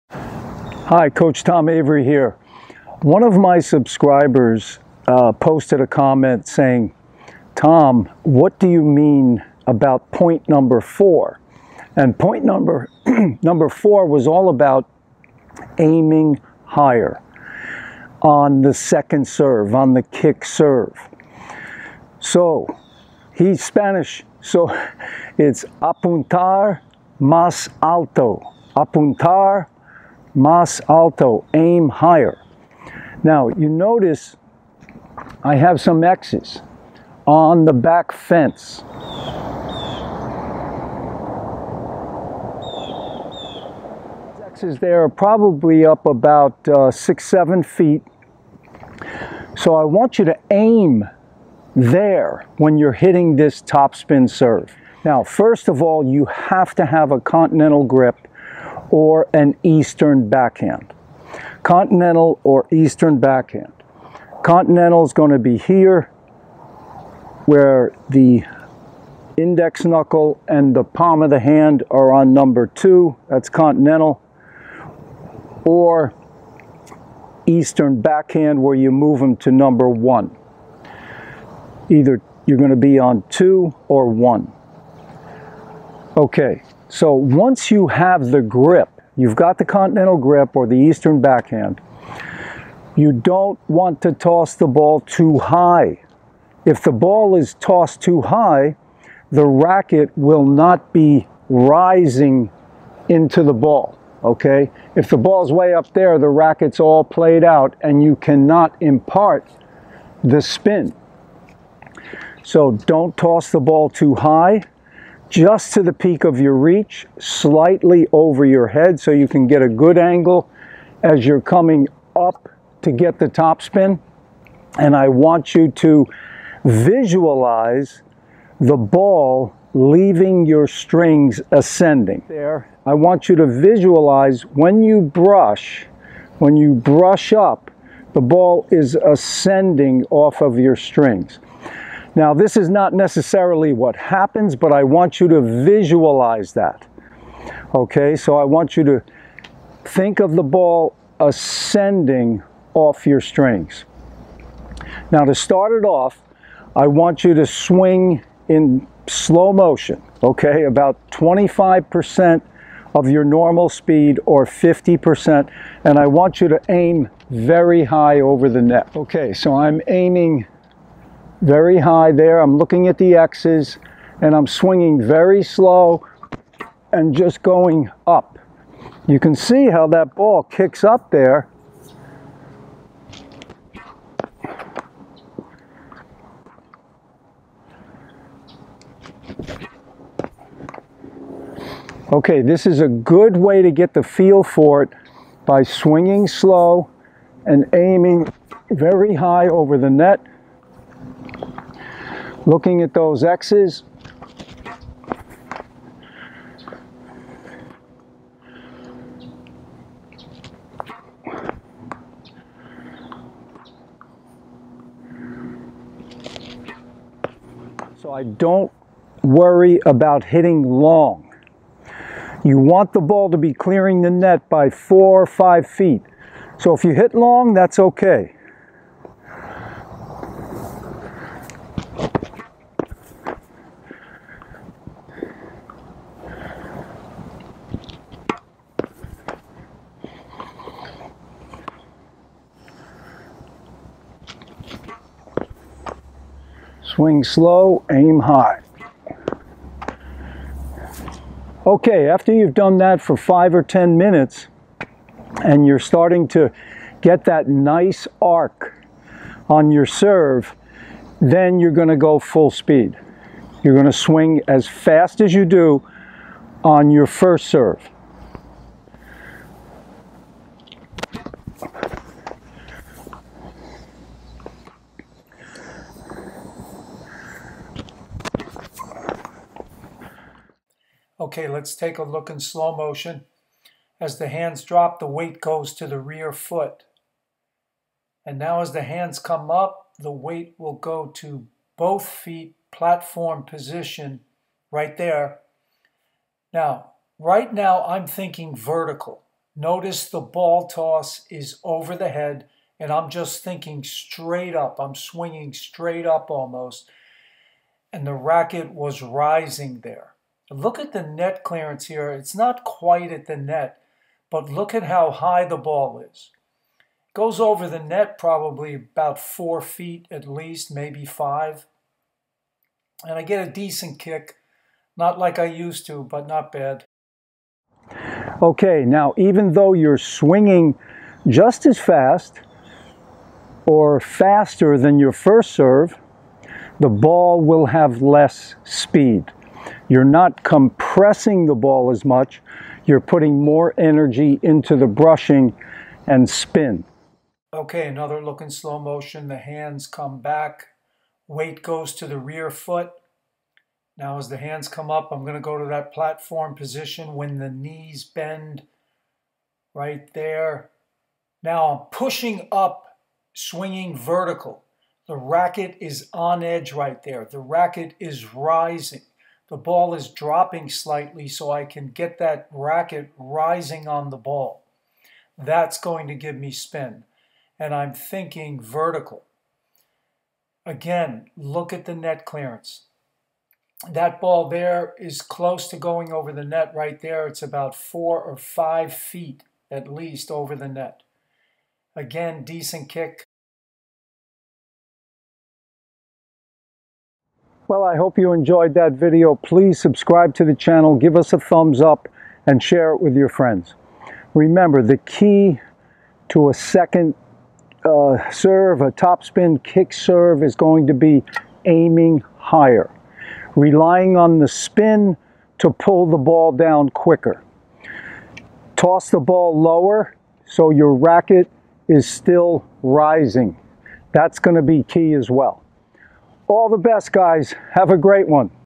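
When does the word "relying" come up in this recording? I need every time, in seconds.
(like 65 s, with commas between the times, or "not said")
413 s.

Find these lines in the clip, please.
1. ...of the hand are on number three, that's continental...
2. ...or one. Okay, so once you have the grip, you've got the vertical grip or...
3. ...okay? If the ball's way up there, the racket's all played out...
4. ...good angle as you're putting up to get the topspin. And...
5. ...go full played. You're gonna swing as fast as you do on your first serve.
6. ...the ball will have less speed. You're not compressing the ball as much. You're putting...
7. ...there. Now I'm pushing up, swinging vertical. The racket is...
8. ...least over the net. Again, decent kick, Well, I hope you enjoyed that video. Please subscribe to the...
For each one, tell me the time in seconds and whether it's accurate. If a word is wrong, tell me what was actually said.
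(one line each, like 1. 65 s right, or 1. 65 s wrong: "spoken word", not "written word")
1. 71 s wrong: "two", not "three"
2. 83 s wrong: "continental", not "vertical"
3. 104 s right
4. 119 s wrong: "coming", not "putting"
5. 261 s wrong: "speed", not "played"
6. 336 s right
7. 360 s right
8. 389 s right.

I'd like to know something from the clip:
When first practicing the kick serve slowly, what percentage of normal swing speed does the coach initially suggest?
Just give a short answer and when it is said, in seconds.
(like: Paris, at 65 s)
25%, at 161 s.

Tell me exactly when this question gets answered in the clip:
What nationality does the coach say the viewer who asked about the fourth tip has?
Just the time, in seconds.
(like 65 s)
23 s.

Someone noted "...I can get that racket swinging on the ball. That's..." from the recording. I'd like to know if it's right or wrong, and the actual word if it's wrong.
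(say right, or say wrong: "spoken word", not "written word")
wrong: "rising", not "swinging".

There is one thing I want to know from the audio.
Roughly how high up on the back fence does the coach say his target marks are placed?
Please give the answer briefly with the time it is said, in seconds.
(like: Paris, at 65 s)
6 or 7 feet, at 46 s.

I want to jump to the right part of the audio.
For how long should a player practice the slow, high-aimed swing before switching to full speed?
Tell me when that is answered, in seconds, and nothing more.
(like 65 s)
253 s.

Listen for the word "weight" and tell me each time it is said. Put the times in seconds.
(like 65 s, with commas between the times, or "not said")
285 s, 290 s, 351 s.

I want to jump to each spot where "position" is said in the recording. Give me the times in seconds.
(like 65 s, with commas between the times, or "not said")
293 s, 356 s.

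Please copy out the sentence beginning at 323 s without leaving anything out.
And I get a decent kick.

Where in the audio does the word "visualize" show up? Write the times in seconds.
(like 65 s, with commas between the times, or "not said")
126 s, 133 s, 145 s.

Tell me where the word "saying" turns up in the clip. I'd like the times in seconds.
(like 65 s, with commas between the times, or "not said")
6 s.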